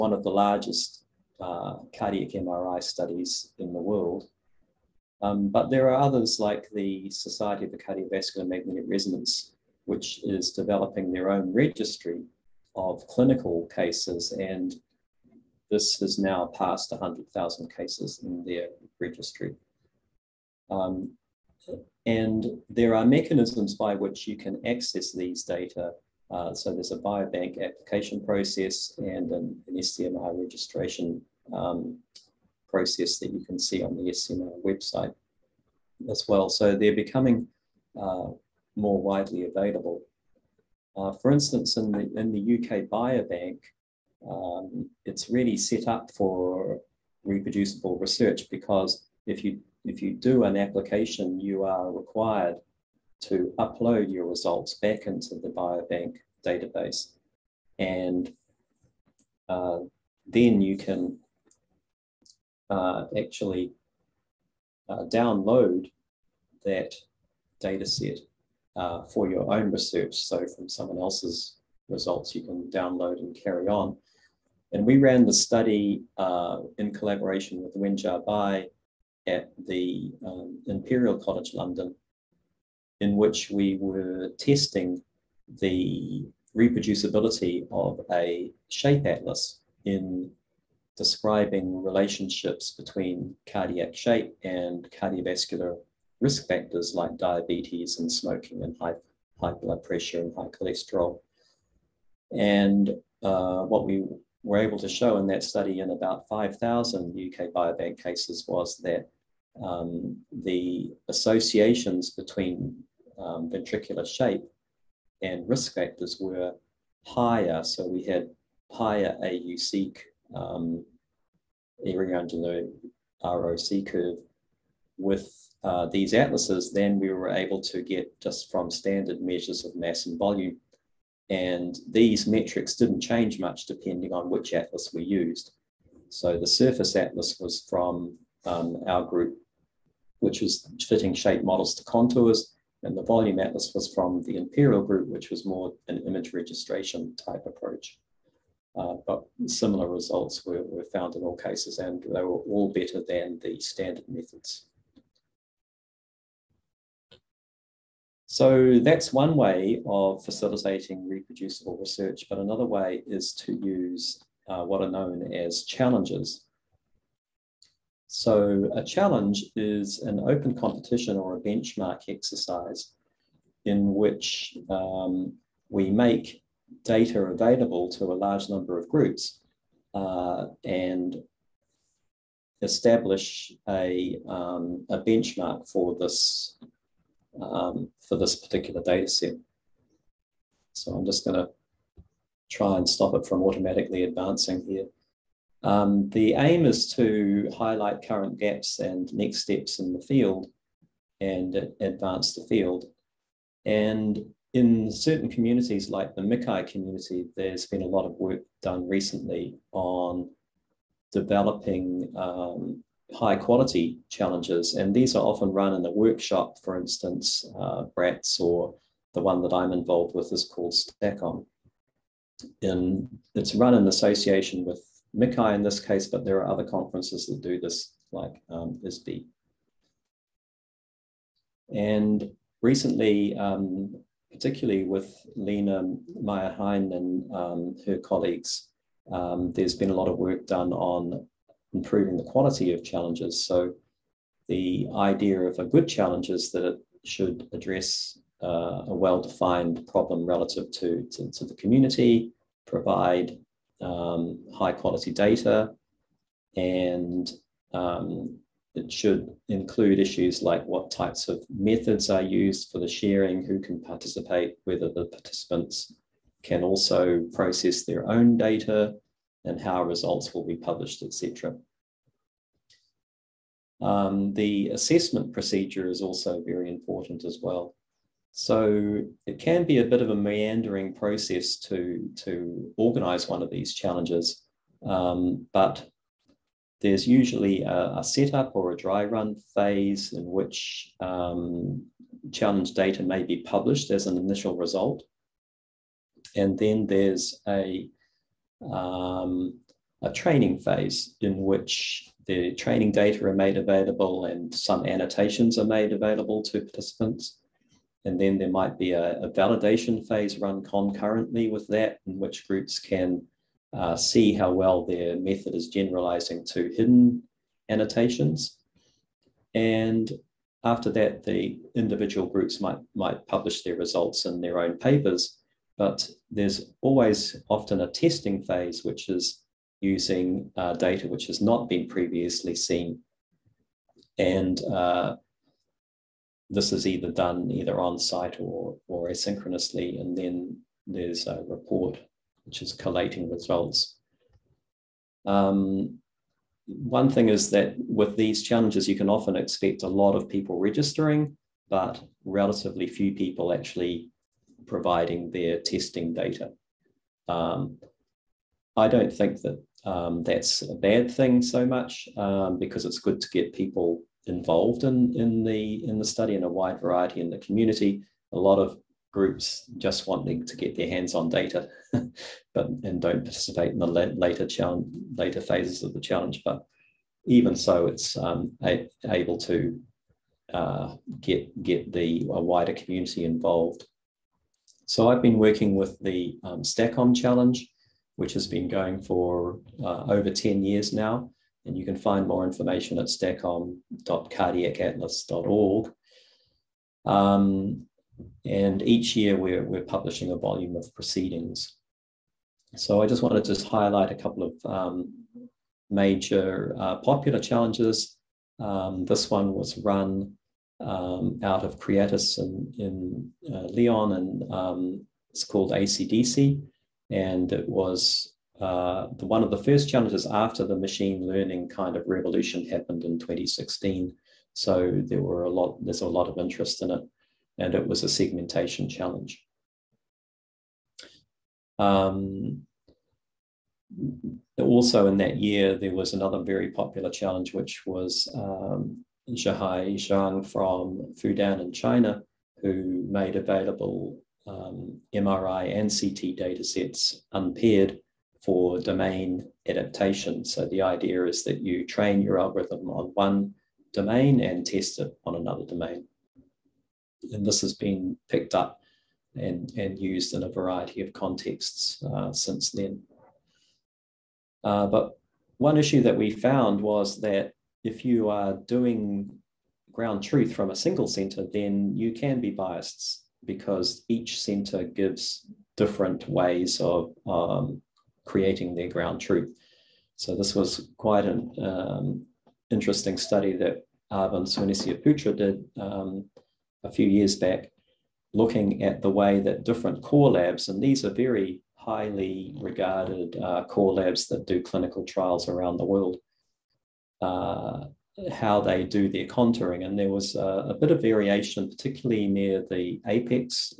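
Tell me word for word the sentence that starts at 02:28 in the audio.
Uh, but similar results were, were found in all cases, and they were all better than the standard methods.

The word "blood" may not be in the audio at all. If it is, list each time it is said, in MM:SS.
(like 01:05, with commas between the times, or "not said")
01:39.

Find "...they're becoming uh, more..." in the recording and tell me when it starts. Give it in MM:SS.
00:36.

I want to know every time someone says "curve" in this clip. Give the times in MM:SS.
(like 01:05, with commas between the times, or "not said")
02:03.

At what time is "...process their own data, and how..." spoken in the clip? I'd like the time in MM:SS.
04:27.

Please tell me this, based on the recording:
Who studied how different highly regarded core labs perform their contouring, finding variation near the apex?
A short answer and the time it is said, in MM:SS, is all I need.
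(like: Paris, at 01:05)
Avan Suinesiaputra, at 08:04.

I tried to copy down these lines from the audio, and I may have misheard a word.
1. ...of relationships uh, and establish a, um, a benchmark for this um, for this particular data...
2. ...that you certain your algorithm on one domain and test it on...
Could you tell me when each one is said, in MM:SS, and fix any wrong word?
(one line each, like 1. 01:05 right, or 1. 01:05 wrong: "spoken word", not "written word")
1. 02:58 wrong: "groups", not "relationships"
2. 07:31 wrong: "train", not "certain".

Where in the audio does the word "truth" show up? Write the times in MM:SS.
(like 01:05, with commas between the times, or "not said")
07:50, 07:59.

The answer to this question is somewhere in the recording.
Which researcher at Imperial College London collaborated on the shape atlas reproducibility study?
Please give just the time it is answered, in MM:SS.
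01:17.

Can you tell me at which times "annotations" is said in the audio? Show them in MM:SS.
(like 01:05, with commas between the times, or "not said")
05:04, 05:17.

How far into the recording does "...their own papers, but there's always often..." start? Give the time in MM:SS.
05:24.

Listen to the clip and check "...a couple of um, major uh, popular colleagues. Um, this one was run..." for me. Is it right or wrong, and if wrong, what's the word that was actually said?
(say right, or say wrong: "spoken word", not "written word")
wrong: "challenges", not "colleagues".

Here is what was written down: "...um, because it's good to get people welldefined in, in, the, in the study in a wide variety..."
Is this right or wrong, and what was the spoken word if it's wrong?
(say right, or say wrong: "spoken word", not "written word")
wrong: "involved", not "welldefined".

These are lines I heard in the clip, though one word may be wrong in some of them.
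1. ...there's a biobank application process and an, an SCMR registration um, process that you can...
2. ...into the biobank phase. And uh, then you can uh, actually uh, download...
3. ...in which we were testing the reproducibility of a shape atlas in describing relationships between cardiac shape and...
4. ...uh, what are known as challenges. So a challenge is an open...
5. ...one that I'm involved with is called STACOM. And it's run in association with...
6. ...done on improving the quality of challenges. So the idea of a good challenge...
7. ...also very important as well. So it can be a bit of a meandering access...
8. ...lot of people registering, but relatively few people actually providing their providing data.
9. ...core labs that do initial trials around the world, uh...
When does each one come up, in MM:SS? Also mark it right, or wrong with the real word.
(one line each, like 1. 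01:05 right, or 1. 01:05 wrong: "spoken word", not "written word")
1. 00:26 right
2. 00:55 wrong: "database", not "phase"
3. 01:23 right
4. 02:44 right
5. 03:39 right
6. 04:00 right
7. 04:36 wrong: "process", not "access"
8. 05:49 wrong: "testing", not "providing"
9. 08:13 wrong: "clinical", not "initial".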